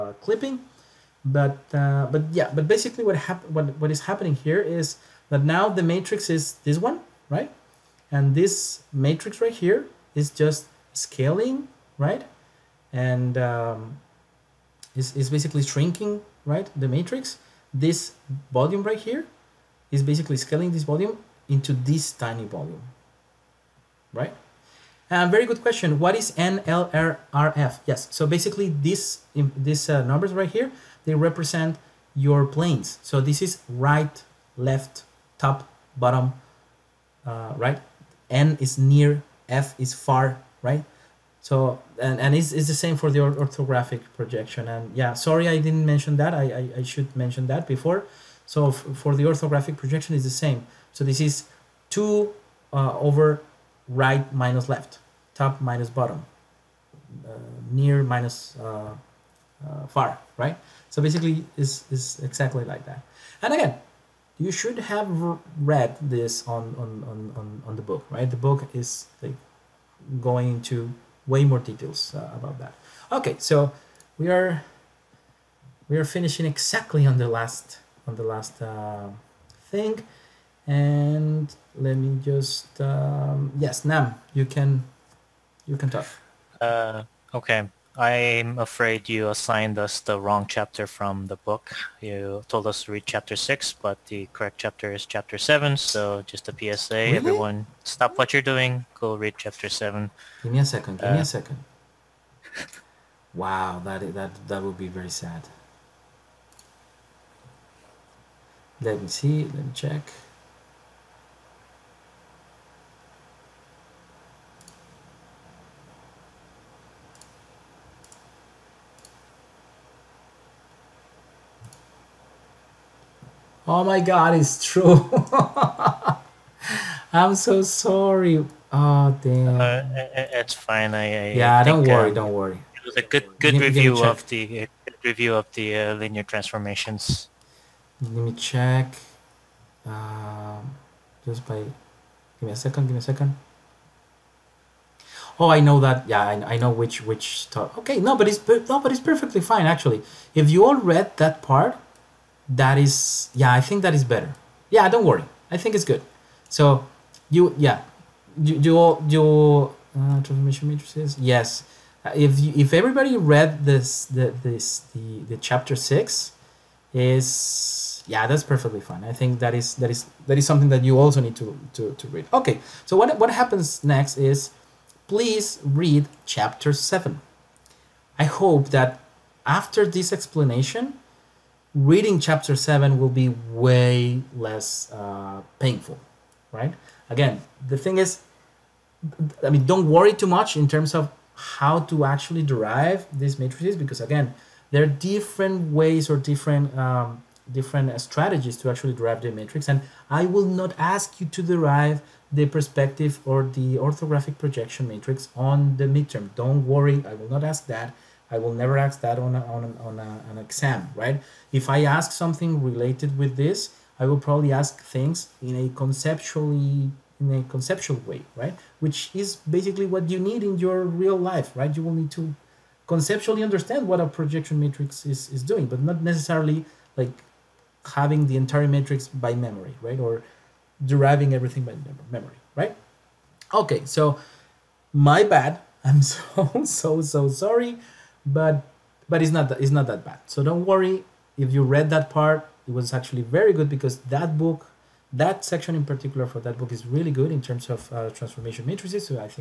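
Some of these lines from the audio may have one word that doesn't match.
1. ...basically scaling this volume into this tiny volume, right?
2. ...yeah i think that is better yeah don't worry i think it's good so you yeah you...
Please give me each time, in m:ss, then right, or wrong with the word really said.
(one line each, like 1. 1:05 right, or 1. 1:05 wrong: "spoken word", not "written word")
1. 0:20 right
2. 2:33 right.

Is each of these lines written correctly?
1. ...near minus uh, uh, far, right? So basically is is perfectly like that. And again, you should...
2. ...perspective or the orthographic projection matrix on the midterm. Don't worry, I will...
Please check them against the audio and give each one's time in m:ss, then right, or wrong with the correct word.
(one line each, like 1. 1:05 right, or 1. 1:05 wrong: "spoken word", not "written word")
1. 0:57 wrong: "exactly", not "perfectly"
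2. 3:22 right.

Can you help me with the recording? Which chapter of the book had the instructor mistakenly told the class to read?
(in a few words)
Chapter 6.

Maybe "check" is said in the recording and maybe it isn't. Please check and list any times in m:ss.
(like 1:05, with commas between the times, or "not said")
1:49, 2:18.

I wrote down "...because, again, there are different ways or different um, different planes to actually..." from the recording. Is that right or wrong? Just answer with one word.
wrong.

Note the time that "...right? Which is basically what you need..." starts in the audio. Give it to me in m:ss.
3:38.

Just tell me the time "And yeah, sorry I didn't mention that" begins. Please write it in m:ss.
0:44.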